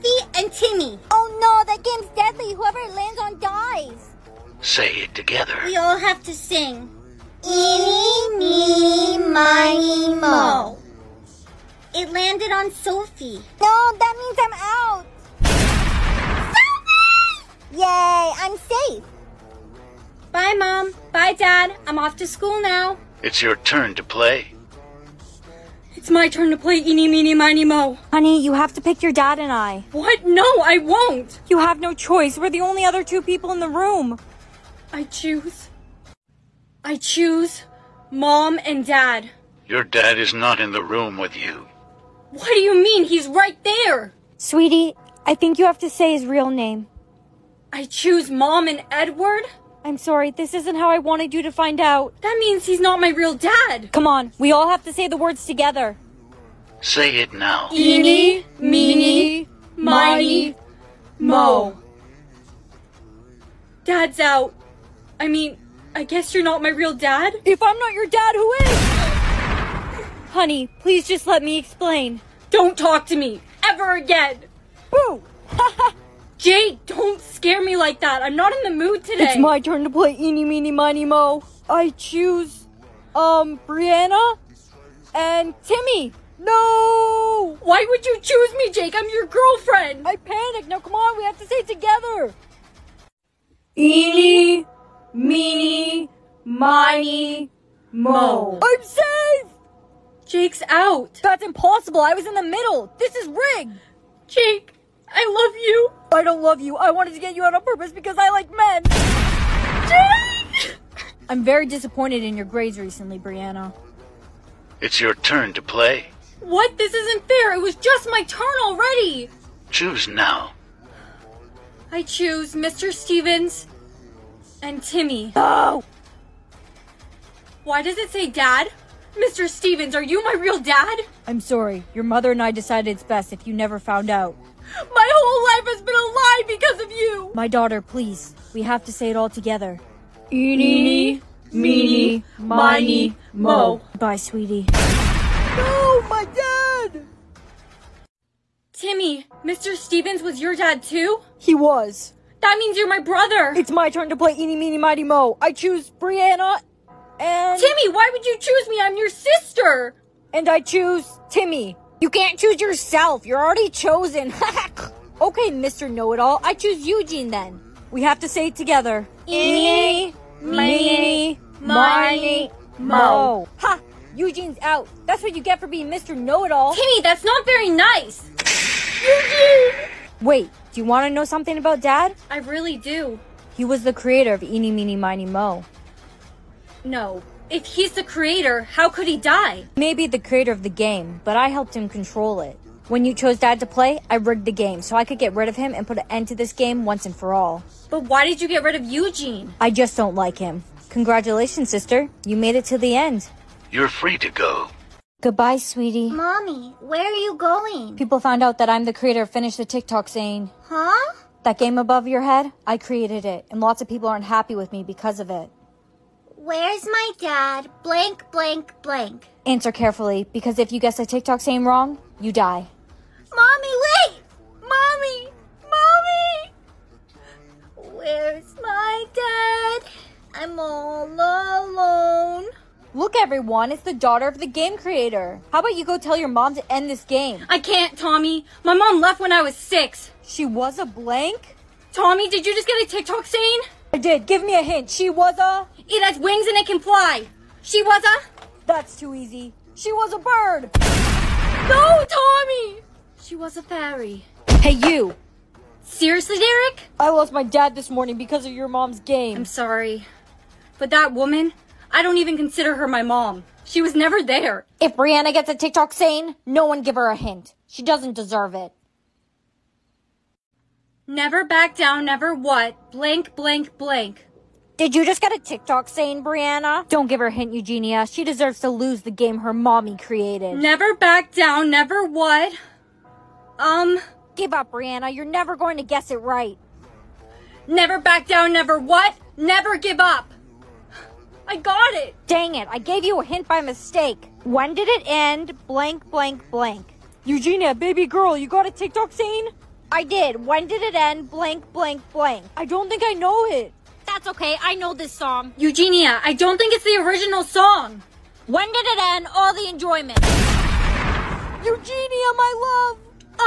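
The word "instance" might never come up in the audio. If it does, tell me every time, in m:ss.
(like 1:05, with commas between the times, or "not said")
not said.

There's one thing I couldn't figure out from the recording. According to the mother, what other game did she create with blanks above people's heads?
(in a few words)
Finish the TikTok saying.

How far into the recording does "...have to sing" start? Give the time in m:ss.
0:05.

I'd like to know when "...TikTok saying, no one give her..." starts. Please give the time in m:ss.
4:25.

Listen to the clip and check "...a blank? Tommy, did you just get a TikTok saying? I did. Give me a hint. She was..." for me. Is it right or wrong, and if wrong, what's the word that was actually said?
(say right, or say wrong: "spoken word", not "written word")
right.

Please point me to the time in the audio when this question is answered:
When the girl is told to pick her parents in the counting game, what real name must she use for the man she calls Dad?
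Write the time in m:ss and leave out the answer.
0:48.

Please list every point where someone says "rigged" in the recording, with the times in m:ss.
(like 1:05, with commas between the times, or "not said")
1:43, 3:14.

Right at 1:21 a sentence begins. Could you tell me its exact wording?
I choose, um, Brianna and Timmy.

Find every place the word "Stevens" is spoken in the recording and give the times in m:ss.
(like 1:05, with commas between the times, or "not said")
2:02, 2:09, 2:29.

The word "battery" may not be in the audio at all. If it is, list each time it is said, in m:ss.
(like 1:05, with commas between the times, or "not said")
not said.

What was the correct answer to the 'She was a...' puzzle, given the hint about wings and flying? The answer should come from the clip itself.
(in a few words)
fairy.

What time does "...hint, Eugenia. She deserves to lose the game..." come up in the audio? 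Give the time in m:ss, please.
4:37.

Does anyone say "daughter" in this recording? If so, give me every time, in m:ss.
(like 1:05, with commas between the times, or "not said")
2:17, 3:53.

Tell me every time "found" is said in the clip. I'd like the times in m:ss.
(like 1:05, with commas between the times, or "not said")
2:13, 3:28.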